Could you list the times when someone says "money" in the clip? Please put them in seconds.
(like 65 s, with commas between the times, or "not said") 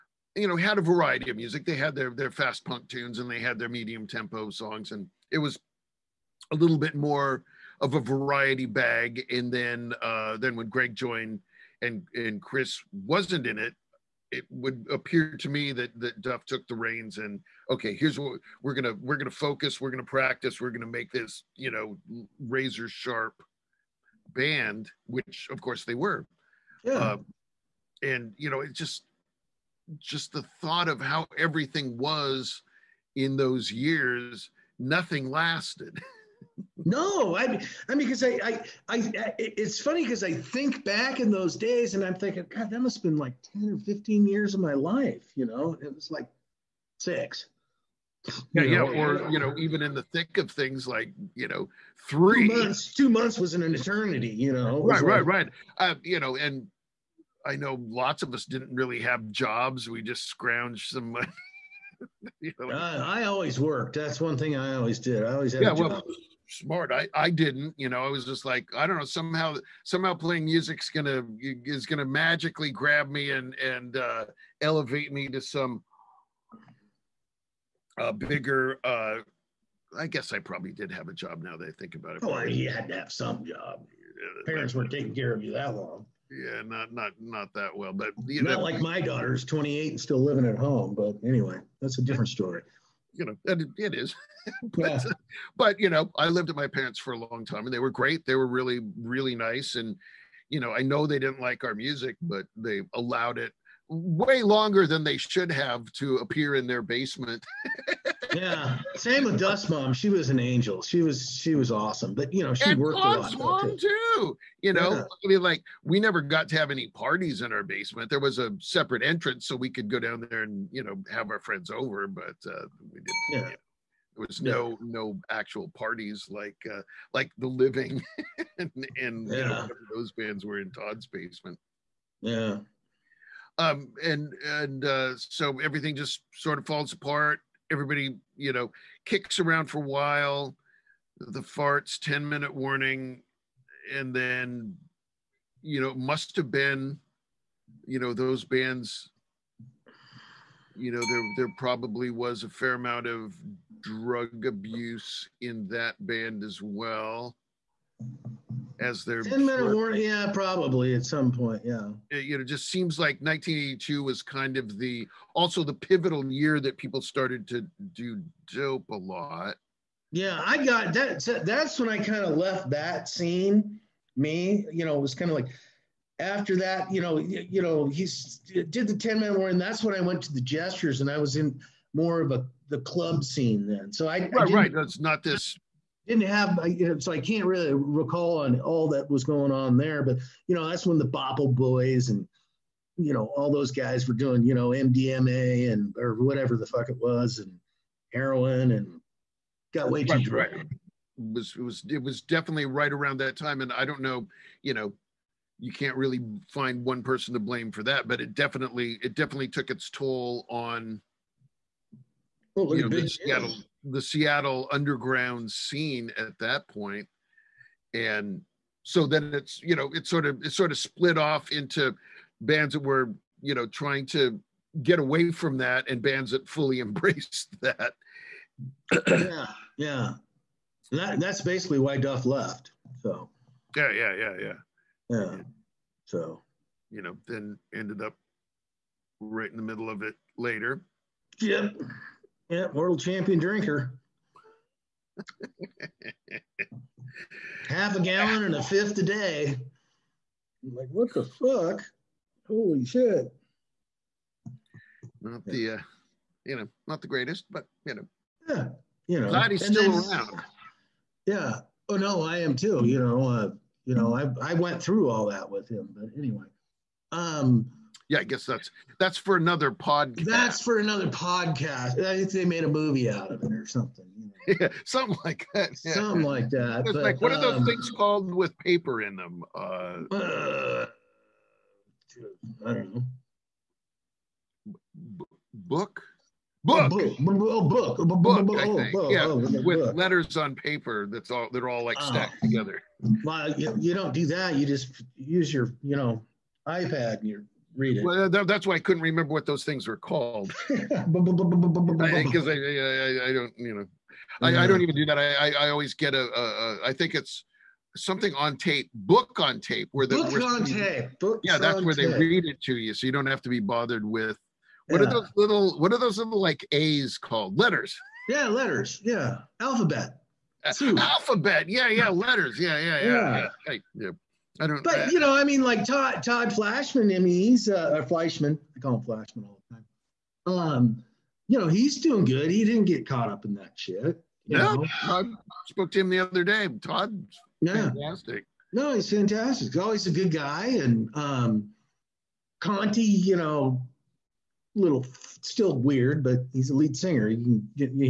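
61 s.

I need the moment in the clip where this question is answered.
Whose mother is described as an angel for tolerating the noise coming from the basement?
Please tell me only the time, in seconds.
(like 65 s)
109 s.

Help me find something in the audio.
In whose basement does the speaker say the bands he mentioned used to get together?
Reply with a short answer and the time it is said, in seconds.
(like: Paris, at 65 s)
Todd's basement, at 130 s.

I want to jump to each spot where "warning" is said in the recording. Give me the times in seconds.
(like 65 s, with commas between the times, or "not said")
142 s, 159 s, 179 s.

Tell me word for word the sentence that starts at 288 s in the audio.
Oh, yeah, with letters on paper.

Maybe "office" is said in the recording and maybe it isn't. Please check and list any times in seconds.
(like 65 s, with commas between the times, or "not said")
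not said.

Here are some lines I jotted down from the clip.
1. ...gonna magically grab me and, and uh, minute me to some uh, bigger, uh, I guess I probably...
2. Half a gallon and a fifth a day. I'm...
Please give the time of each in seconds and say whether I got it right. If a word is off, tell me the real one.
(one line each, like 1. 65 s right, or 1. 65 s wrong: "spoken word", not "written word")
1. 71 s wrong: "elevate", not "minute"
2. 247 s right.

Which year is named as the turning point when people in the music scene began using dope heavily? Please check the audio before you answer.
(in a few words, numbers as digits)
1982.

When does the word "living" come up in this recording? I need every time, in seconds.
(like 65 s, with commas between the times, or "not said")
90 s, 127 s.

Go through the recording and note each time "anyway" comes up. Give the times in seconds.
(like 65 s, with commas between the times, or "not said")
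91 s, 266 s.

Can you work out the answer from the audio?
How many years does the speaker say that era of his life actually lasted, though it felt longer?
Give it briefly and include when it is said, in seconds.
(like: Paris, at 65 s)
6, at 46 s.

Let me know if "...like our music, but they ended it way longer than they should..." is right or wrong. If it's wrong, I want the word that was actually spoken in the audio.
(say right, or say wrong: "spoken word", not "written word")
wrong: "allowed", not "ended".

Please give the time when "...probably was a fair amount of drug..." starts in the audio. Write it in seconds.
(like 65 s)
151 s.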